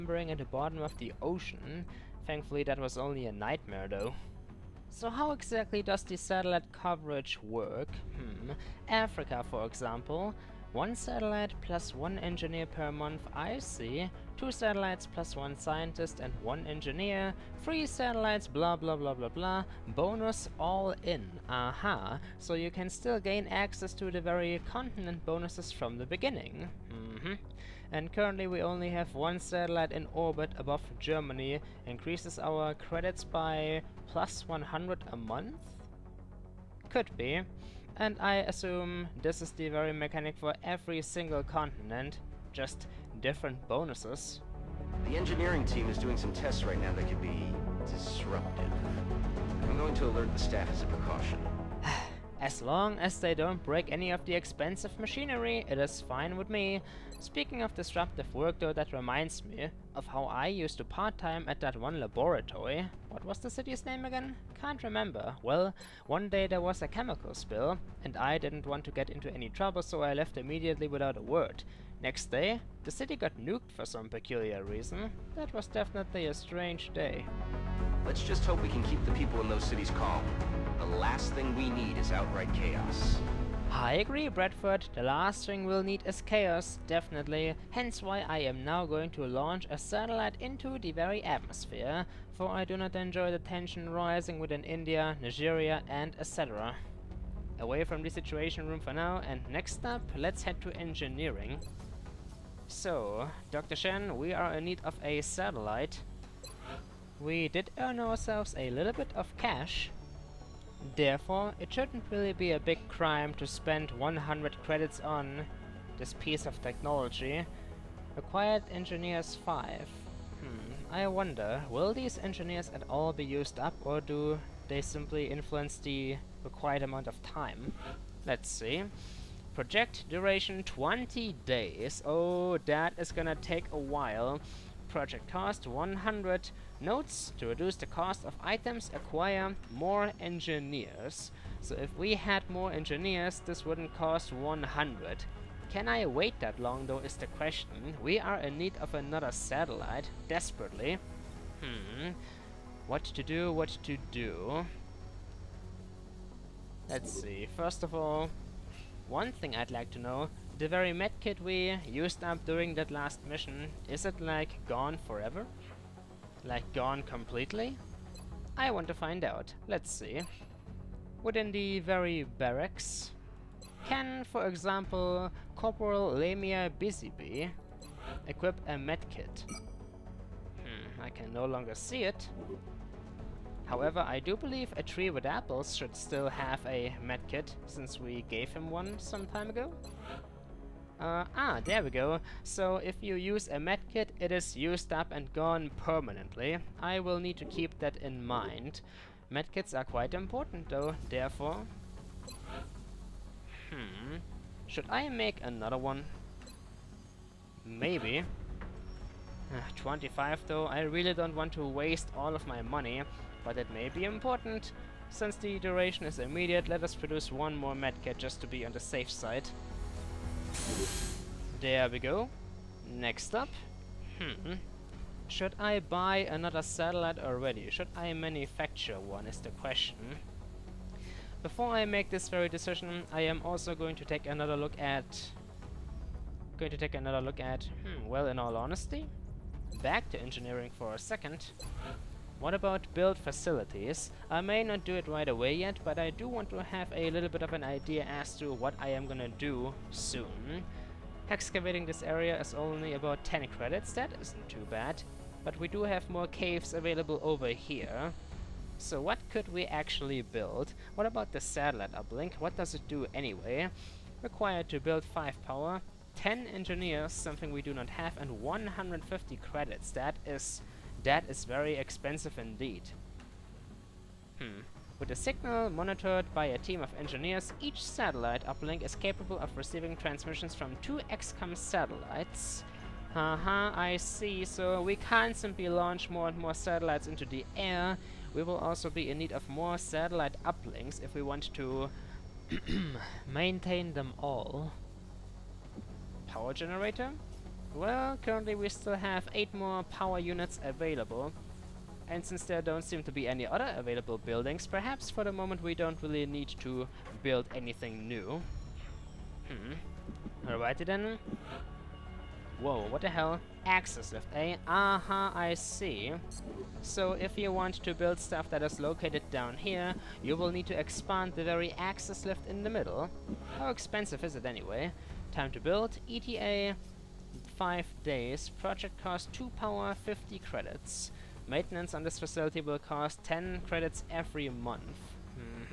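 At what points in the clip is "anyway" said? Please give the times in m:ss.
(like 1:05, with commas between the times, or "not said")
4:23, 5:24.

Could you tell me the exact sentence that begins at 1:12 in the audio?
Next day, the city got nuked for some peculiar reason.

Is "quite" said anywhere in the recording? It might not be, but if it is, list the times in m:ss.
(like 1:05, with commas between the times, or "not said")
3:19.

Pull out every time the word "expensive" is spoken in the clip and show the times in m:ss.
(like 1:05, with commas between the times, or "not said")
0:54, 4:31, 5:23.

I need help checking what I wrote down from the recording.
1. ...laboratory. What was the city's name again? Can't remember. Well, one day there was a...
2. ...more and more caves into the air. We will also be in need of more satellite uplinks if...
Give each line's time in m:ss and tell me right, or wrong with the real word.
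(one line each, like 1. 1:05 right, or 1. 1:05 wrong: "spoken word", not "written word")
1. 1:02 right
2. 4:46 wrong: "satellites", not "caves".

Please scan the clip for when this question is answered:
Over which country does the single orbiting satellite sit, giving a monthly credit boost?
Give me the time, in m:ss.
0:30.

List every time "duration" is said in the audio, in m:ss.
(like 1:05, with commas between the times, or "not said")
2:10, 3:35.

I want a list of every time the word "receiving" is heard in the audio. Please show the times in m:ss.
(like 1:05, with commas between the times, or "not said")
4:39.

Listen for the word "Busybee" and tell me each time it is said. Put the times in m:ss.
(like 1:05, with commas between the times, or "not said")
2:56.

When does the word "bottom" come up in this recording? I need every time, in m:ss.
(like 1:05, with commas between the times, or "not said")
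0:00.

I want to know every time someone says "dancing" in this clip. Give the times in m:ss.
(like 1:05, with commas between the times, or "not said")
not said.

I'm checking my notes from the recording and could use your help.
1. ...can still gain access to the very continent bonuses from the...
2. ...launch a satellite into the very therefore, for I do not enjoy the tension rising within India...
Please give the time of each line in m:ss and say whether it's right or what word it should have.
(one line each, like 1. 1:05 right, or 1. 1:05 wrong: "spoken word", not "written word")
1. 0:22 right
2. 1:29 wrong: "atmosphere", not "therefore".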